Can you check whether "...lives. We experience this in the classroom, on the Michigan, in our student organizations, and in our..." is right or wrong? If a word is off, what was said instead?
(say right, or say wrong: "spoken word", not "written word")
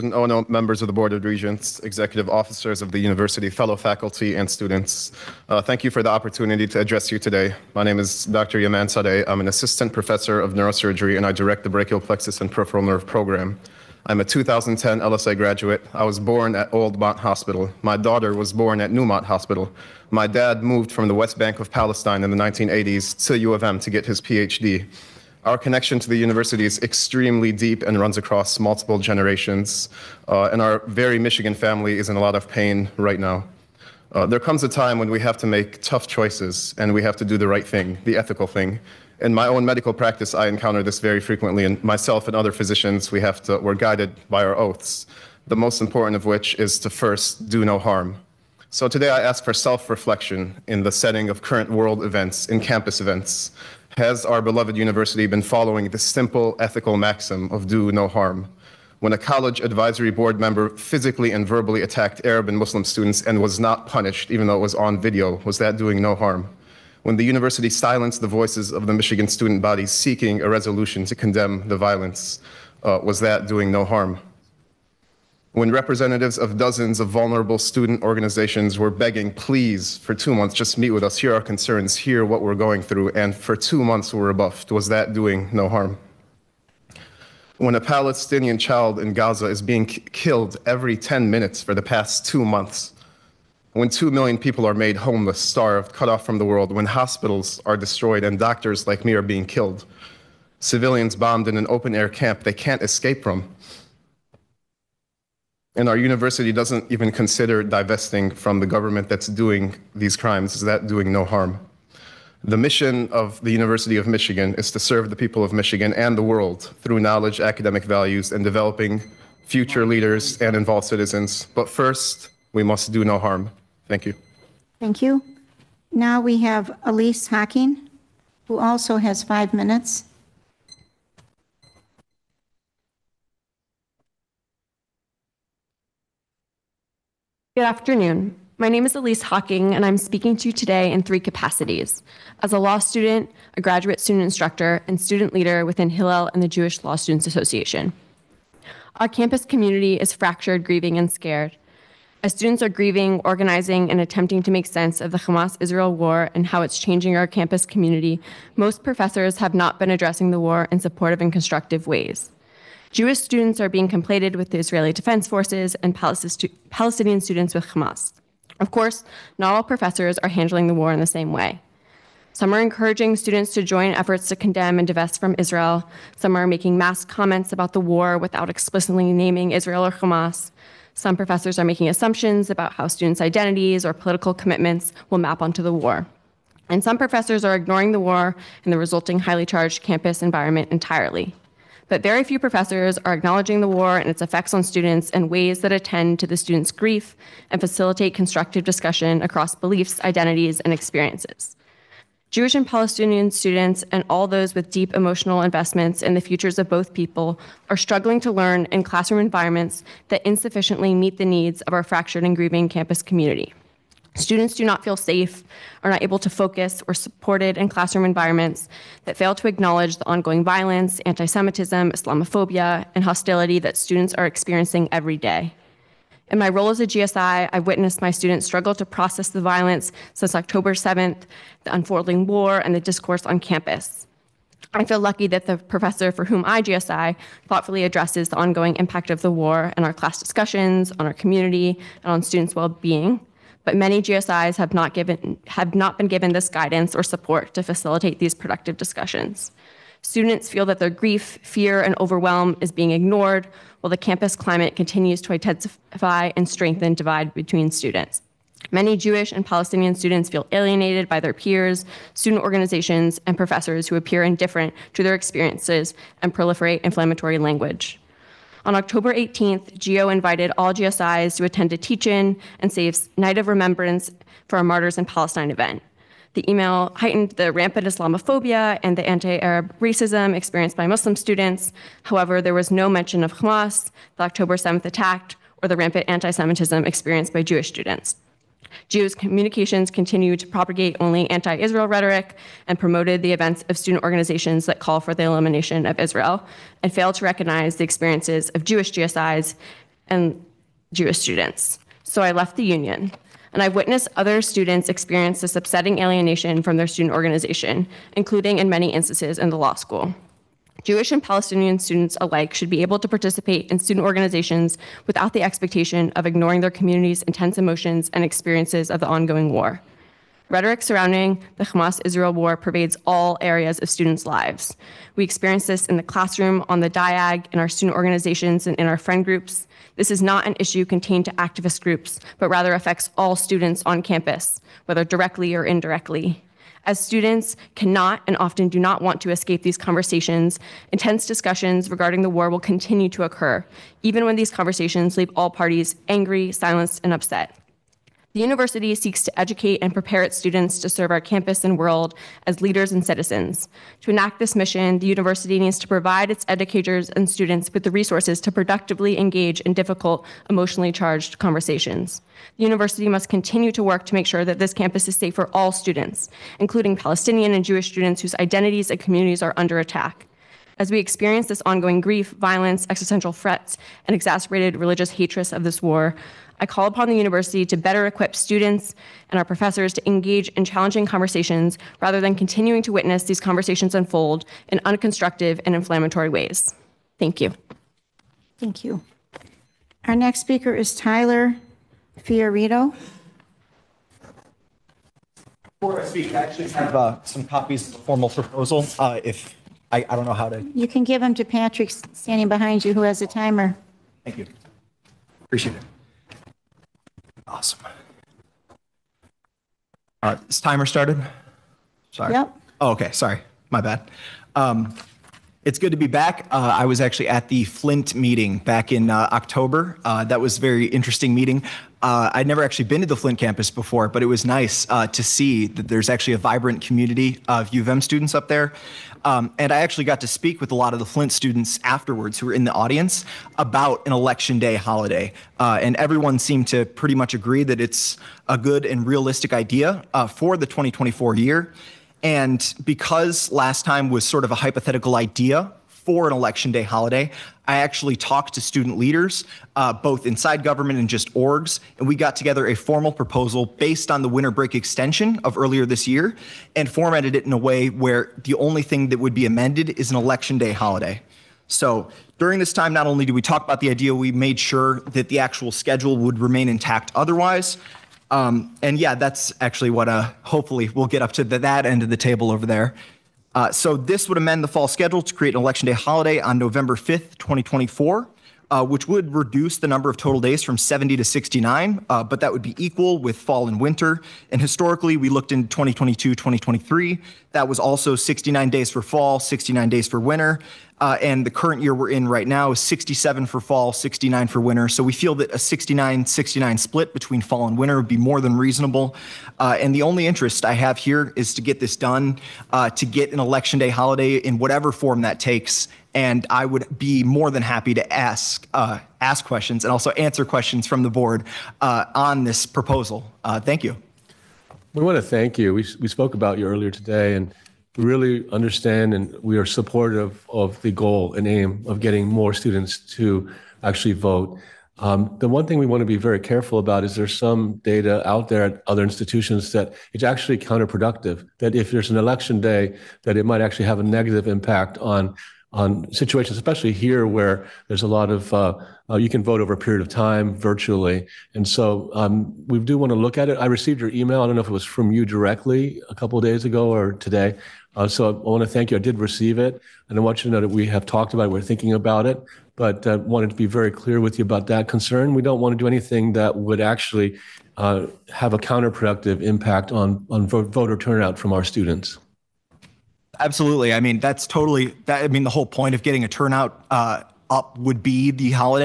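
wrong: "DIAG", not "Michigan".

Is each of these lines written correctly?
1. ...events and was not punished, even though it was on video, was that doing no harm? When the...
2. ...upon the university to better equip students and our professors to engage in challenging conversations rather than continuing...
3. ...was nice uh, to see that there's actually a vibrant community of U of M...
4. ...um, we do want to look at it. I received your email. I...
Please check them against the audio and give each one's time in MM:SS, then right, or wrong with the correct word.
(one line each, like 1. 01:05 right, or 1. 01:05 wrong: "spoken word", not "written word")
1. 01:02 wrong: "students", not "events"
2. 06:16 right
3. 07:04 right
4. 09:02 right.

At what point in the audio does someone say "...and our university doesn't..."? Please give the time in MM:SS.
01:45.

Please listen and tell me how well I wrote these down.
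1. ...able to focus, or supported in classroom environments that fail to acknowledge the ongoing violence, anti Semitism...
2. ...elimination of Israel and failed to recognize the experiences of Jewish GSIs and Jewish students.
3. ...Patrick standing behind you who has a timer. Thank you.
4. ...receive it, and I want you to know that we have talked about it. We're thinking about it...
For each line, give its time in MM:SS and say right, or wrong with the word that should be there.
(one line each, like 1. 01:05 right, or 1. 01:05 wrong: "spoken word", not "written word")
1. 03:36 right
2. 04:55 right
3. 06:41 right
4. 09:09 right.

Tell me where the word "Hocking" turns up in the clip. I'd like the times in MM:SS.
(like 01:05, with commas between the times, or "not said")
02:07, 02:19.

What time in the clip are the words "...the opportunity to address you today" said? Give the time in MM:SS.
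00:06.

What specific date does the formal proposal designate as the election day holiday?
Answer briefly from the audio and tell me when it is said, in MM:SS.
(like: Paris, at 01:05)
November 5th, 2024, at 07:56.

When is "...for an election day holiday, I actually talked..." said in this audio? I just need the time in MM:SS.
07:25.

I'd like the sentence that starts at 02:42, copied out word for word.
Jewish students are being conflated with the Israeli Defense Forces and Palestinian students with Hamas.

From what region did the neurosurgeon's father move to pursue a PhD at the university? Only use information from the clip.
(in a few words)
West Bank.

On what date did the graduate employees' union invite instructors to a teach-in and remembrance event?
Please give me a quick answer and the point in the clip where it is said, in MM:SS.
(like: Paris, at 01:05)
October 18th, at 04:28.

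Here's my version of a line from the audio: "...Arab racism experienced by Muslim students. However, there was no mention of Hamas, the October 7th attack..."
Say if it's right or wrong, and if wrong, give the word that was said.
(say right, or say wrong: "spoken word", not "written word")
right.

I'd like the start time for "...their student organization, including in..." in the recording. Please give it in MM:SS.
05:06.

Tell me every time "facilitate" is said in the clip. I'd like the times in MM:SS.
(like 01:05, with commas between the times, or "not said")
03:17, 04:07.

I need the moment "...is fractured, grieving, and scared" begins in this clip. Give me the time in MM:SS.
02:29.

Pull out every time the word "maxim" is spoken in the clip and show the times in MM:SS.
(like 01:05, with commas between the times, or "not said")
00:56.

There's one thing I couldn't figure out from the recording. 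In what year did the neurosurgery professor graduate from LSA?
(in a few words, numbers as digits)
2010.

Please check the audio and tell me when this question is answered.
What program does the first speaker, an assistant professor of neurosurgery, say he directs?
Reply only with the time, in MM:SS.
00:11.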